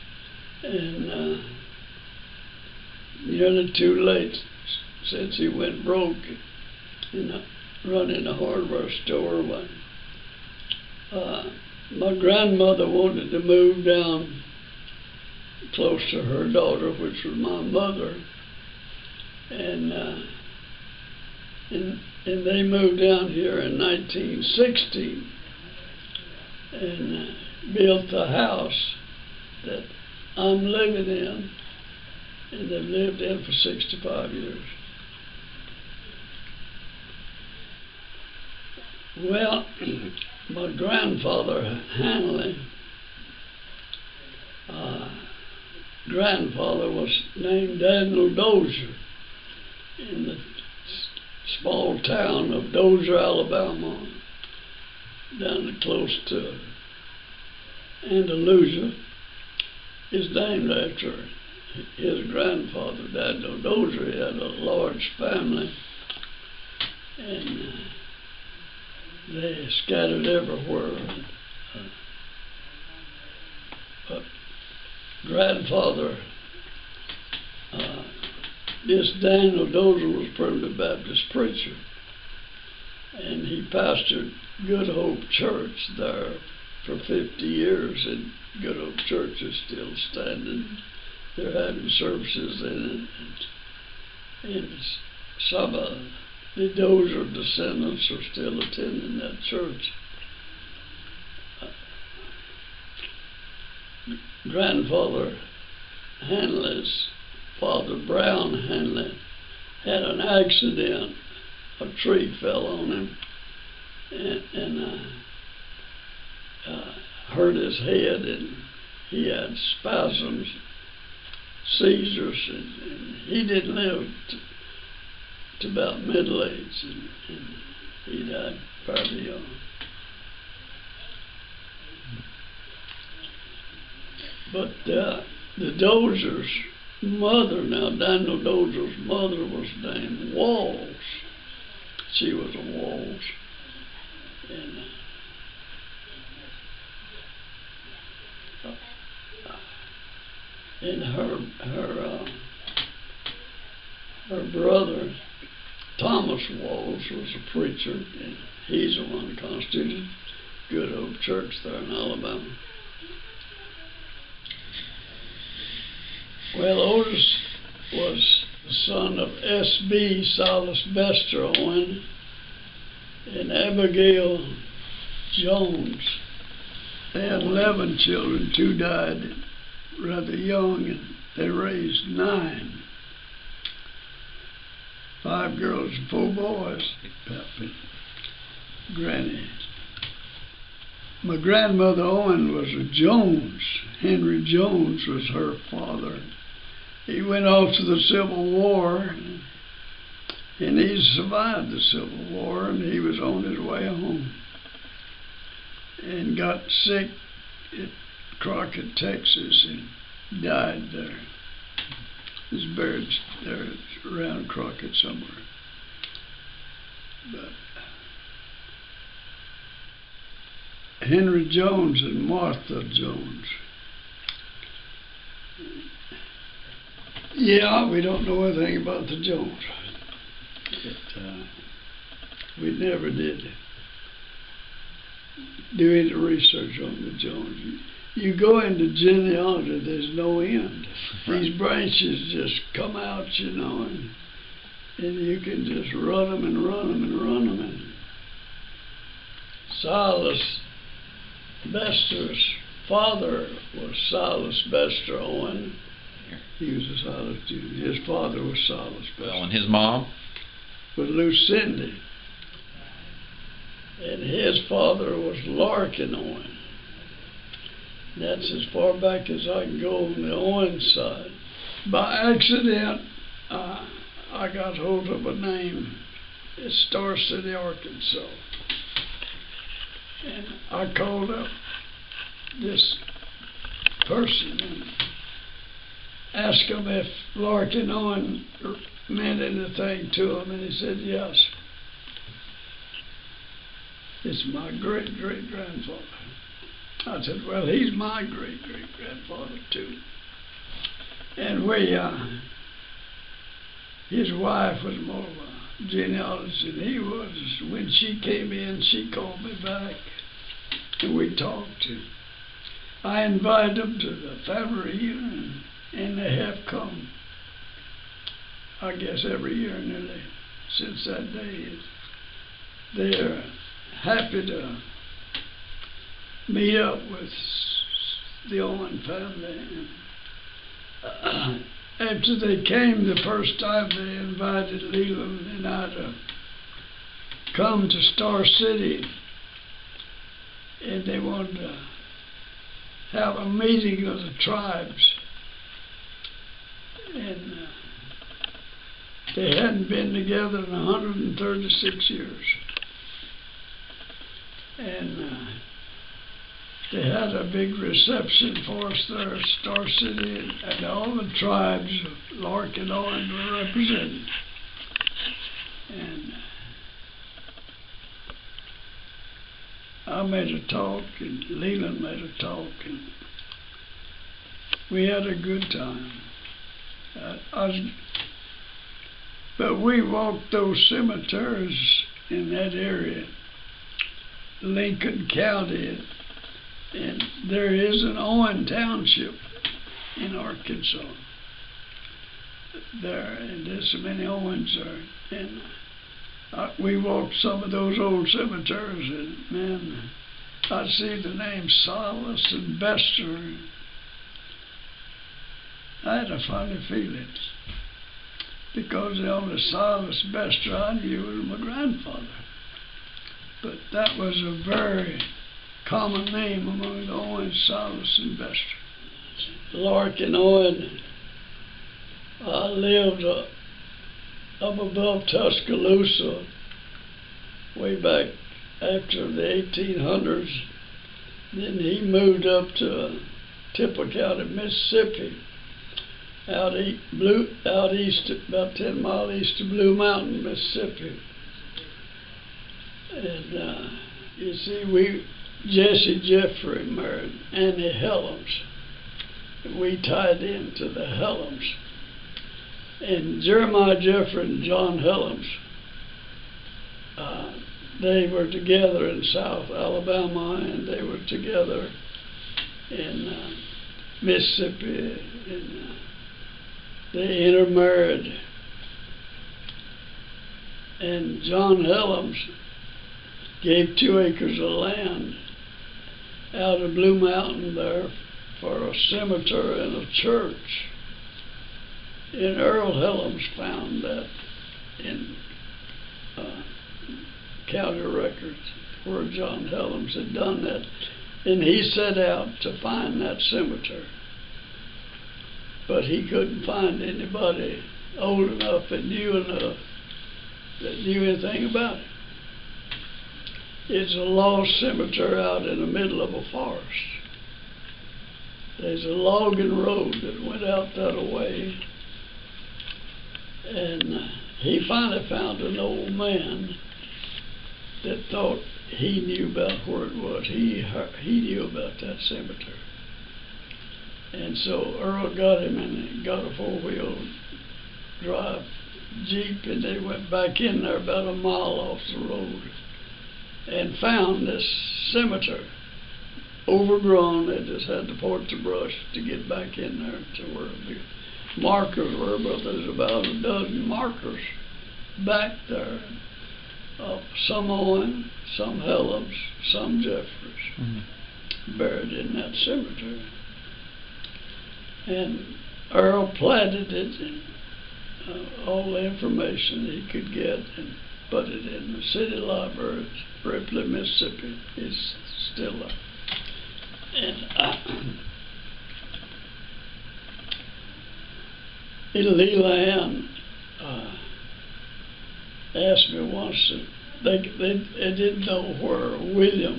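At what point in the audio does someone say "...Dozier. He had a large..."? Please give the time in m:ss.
1:03.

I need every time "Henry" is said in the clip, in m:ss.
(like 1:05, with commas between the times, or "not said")
3:13, 3:41.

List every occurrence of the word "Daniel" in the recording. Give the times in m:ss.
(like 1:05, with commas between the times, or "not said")
0:47, 1:03, 1:19, 2:17.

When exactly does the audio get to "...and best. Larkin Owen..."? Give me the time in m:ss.
6:58.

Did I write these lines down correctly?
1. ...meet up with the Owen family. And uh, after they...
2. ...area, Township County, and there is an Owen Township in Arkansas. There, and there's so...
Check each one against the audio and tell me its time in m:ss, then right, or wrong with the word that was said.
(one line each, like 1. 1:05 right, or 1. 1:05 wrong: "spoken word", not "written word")
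1. 5:26 right
2. 6:22 wrong: "Lincoln", not "Township".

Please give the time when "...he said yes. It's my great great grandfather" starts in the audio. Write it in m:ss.
4:50.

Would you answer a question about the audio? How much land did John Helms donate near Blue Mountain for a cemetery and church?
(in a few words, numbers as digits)
2 acres.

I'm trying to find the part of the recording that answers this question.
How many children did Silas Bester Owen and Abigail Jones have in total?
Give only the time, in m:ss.
2:57.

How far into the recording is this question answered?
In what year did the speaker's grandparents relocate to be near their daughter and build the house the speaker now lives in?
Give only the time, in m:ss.
0:23.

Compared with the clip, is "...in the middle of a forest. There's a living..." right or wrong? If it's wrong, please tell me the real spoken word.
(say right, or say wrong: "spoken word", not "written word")
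wrong: "logging", not "living".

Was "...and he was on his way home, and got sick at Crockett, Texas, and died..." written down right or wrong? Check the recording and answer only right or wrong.
right.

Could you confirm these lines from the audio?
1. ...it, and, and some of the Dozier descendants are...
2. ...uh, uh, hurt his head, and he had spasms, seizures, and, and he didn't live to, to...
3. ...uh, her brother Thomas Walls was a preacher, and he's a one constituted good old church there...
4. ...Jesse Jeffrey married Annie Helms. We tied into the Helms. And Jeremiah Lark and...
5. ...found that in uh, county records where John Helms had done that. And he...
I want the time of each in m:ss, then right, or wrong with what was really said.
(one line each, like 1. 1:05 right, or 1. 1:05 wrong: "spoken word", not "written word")
1. 1:33 right
2. 1:56 right
3. 2:32 right
4. 7:25 wrong: "Jeffrey", not "Lark"
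5. 8:03 right.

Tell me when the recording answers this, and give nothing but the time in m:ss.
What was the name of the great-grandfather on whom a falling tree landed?
1:48.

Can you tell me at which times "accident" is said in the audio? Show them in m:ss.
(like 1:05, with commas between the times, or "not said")
1:50, 4:32.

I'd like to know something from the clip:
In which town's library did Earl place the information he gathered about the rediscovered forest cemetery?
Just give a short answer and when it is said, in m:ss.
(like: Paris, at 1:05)
Ripley, Mississippi, at 9:23.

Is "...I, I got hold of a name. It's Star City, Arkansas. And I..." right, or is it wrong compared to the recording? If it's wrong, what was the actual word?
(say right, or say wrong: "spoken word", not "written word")
right.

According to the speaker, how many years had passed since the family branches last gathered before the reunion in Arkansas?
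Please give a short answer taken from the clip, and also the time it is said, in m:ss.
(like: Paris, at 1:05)
136, at 5:50.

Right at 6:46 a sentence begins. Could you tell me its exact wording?
I had a funny feeling because the only psalmist best I knew was my grandfather.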